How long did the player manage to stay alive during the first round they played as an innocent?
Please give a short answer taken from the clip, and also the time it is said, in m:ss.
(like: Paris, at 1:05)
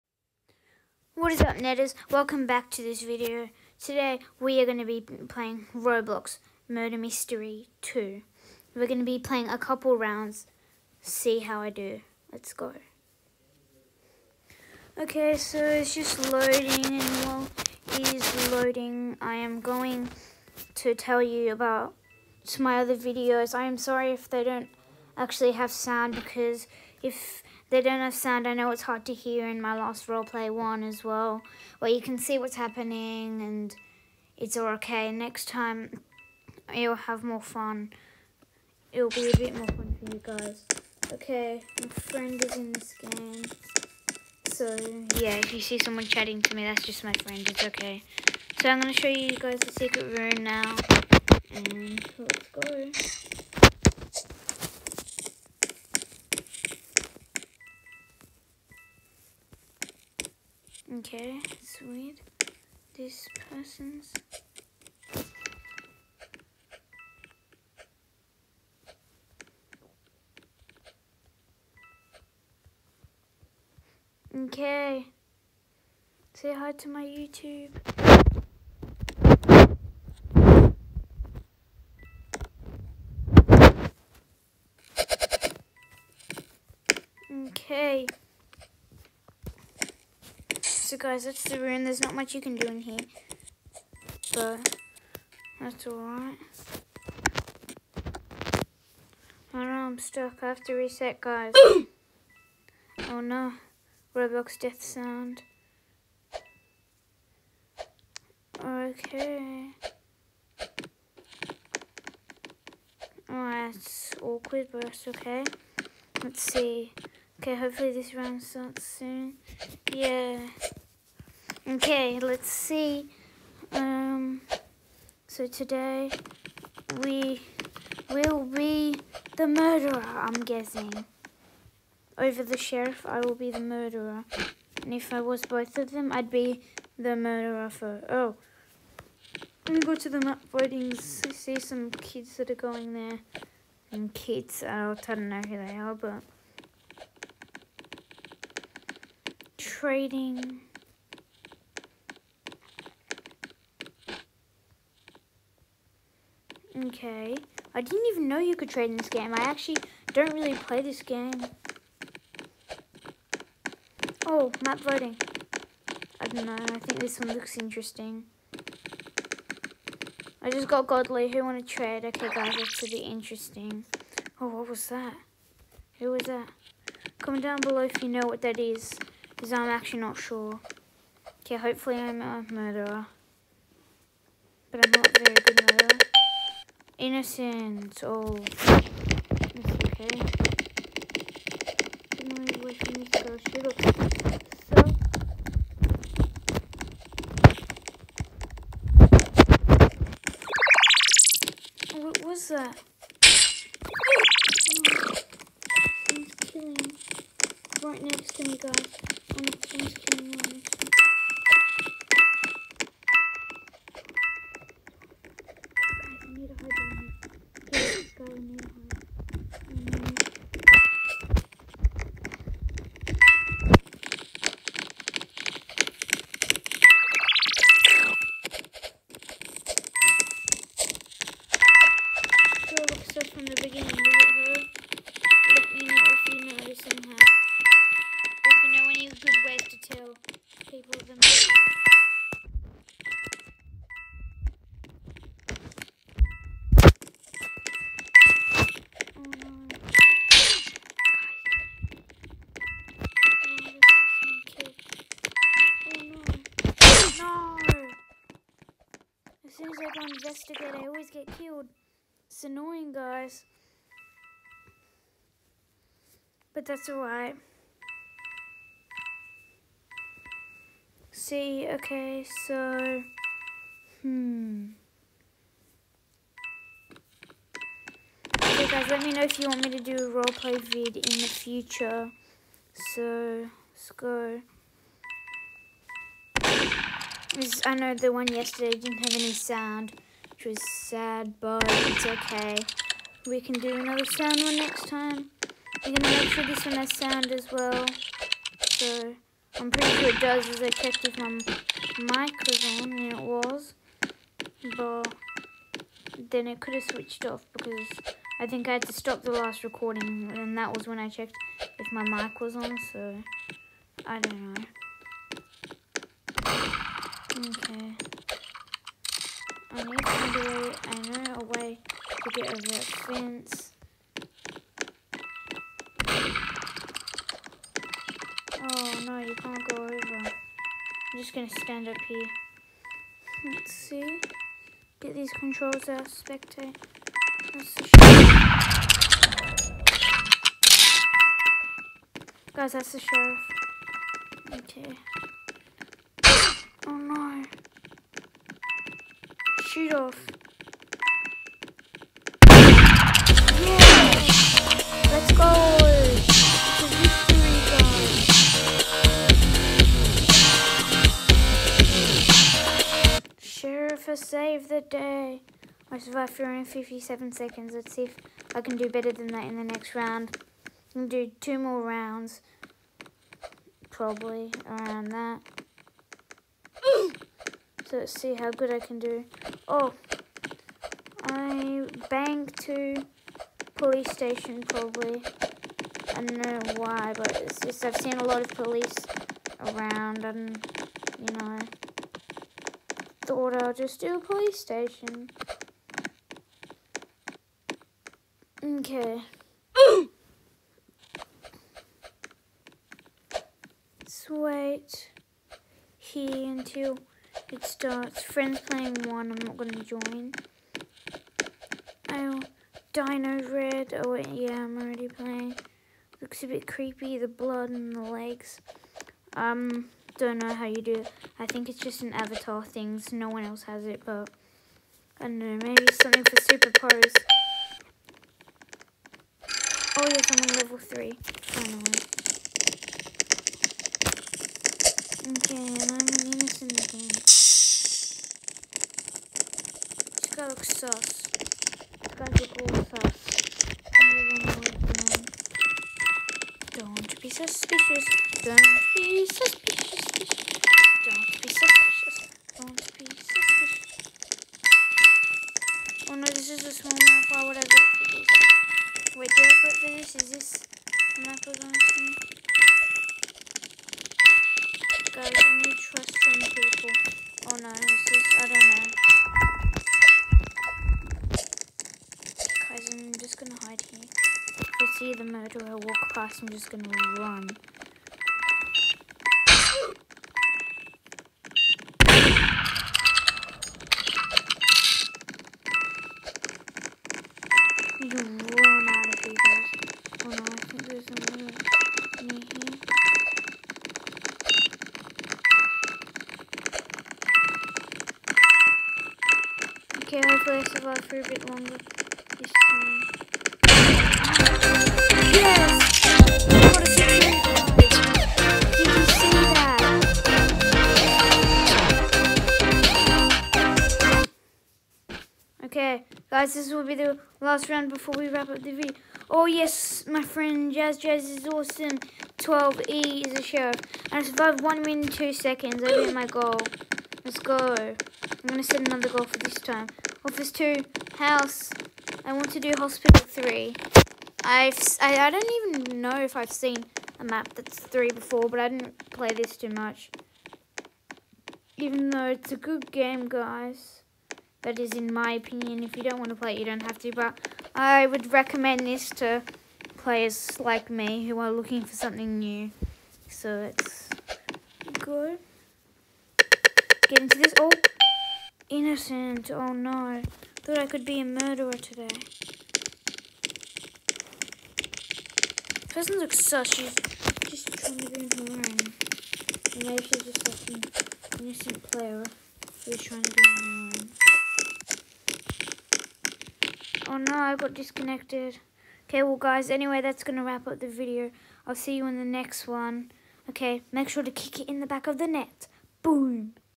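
57 seconds, at 6:06.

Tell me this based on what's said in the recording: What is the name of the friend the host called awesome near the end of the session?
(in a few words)
Jazz.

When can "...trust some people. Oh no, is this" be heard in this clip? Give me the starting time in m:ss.
7:45.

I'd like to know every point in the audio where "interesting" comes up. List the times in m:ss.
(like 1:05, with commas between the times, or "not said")
2:47, 2:52.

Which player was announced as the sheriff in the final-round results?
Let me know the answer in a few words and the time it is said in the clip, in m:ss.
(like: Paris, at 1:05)
12E, at 8:42.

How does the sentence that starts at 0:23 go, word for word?
I am sorry if they don't actually have sound, because if they don't have sound.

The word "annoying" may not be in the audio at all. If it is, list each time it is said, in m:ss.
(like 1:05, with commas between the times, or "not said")
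4:22, 9:28, 9:33.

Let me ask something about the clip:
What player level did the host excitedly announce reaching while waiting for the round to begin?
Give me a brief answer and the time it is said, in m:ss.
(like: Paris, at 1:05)
Level 3, at 7:10.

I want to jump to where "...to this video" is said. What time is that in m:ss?
0:02.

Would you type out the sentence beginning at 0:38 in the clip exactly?
It'll be a bit more fun for you guys.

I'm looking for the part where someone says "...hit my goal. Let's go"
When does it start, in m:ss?
8:45.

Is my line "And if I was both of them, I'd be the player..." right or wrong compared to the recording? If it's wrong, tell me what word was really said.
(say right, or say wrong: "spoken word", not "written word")
wrong: "murderer", not "player".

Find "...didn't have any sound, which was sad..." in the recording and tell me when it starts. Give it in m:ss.
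4:48.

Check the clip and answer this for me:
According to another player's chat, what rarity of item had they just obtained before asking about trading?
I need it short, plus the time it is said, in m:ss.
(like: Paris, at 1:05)
Godly, at 2:50.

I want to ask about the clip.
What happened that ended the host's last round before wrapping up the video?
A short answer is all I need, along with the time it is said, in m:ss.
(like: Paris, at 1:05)
Got disconnected, at 9:37.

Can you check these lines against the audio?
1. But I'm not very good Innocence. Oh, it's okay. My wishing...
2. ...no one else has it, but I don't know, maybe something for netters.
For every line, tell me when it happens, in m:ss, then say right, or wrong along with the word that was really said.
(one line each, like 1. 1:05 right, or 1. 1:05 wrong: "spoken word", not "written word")
1. 3:04 right
2. 7:03 wrong: "superpowers", not "netters".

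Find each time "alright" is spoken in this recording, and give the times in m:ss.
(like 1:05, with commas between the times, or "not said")
1:35, 4:26.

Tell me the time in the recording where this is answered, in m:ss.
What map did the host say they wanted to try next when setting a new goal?
8:52.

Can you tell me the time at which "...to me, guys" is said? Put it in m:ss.
3:28.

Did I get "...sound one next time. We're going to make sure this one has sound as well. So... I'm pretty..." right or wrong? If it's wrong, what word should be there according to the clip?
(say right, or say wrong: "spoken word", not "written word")
right.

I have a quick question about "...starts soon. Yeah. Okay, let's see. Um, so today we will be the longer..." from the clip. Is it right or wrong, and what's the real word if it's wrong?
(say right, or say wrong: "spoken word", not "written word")
wrong: "murderer", not "longer".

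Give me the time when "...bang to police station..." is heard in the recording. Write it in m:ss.
6:22.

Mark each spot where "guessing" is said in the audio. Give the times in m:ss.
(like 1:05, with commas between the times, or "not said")
2:10.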